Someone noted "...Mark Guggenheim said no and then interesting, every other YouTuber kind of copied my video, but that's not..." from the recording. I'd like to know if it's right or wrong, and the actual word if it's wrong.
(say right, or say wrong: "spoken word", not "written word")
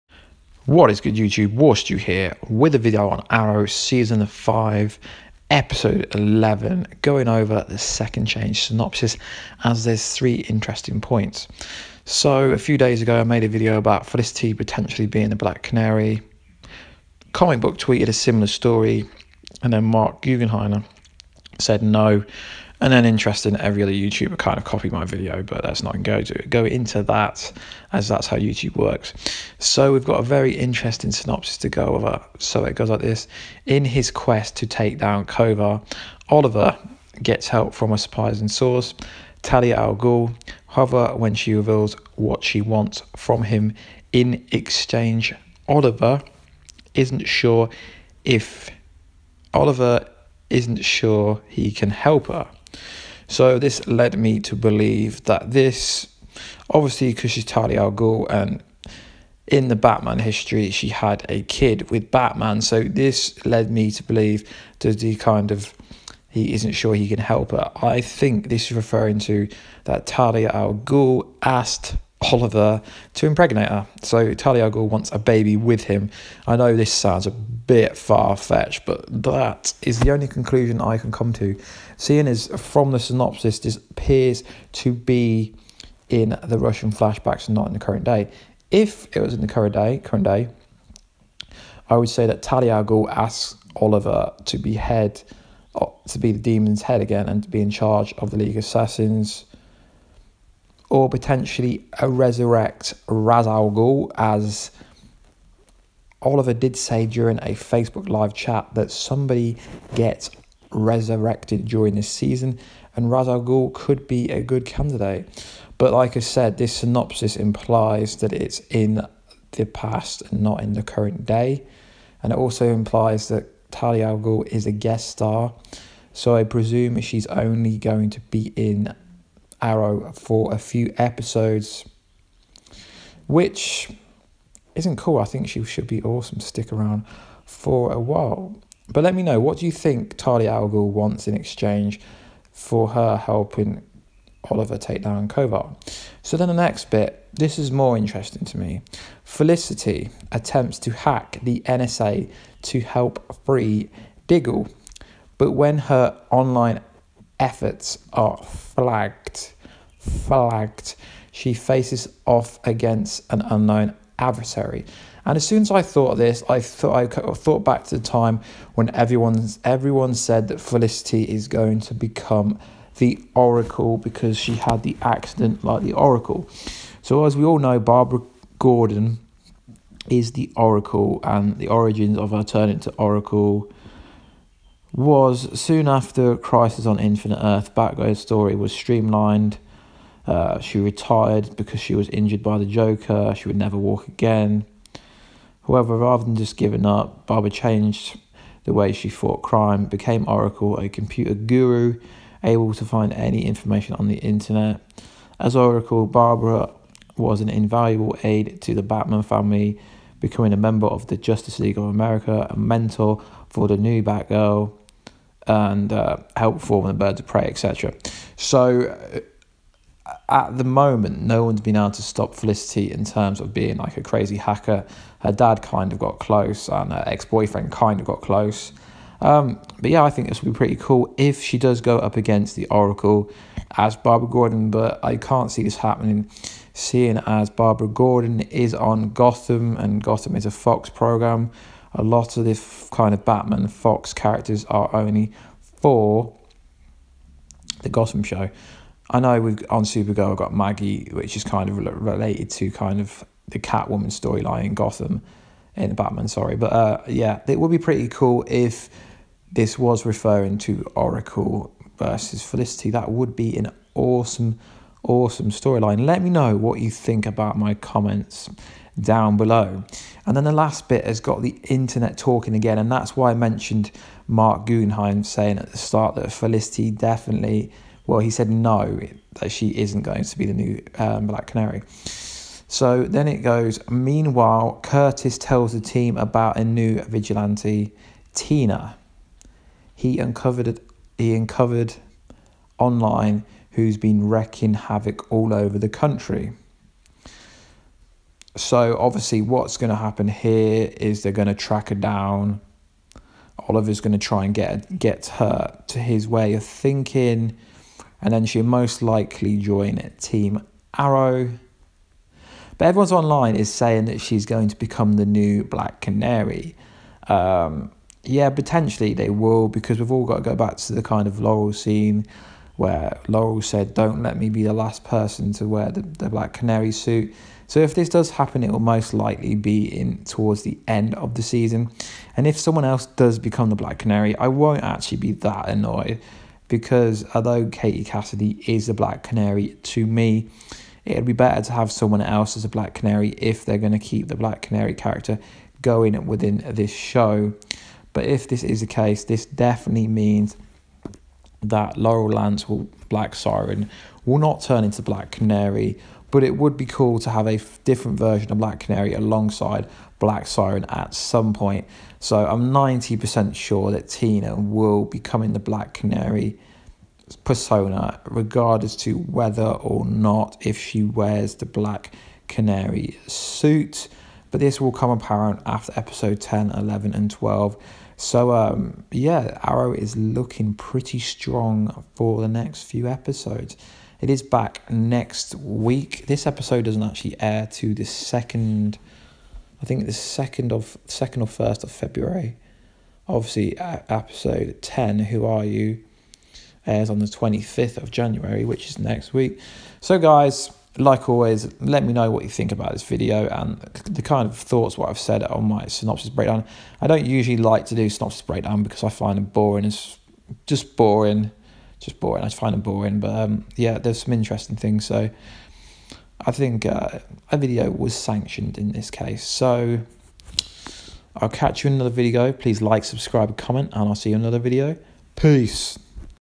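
right.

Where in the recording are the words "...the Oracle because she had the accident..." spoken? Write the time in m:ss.
2:52.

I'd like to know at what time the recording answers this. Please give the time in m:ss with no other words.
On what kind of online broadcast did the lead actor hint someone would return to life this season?
1:47.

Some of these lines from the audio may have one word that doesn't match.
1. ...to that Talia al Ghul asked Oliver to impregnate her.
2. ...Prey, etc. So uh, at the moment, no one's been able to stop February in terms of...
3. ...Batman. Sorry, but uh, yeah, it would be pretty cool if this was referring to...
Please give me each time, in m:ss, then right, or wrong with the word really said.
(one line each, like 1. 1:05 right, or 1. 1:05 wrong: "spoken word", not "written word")
1. 1:09 right
2. 3:37 wrong: "Felicity", not "February"
3. 4:15 right.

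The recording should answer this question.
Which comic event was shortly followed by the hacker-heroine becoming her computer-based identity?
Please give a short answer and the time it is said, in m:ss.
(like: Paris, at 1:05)
Crisis on Infinite Earth, at 3:06.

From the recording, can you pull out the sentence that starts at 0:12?
So a few days ago I made a video about Felicity potentially being the Black Canary.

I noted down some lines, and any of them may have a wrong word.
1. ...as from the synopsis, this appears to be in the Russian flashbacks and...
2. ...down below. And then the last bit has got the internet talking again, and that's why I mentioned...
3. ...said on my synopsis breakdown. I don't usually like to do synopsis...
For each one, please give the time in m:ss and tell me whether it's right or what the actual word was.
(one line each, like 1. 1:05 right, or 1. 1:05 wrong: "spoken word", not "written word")
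1. 1:22 right
2. 4:28 right
3. 6:45 right.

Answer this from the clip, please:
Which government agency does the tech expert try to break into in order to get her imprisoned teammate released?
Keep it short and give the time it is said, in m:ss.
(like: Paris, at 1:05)
NSA, at 2:31.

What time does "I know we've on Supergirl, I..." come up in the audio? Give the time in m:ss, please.
4:09.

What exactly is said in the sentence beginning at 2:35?
But when her online efforts are flagged, flagged, she faces off against an unknown adversary.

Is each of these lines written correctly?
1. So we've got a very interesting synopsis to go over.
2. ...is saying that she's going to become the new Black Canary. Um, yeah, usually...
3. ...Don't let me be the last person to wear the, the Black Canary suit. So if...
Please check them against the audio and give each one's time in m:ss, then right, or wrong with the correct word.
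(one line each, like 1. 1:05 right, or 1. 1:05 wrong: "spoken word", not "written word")
1. 0:29 right
2. 5:13 wrong: "potentially", not "usually"
3. 5:23 right.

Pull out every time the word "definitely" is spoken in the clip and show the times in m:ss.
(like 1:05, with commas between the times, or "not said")
4:36, 5:49.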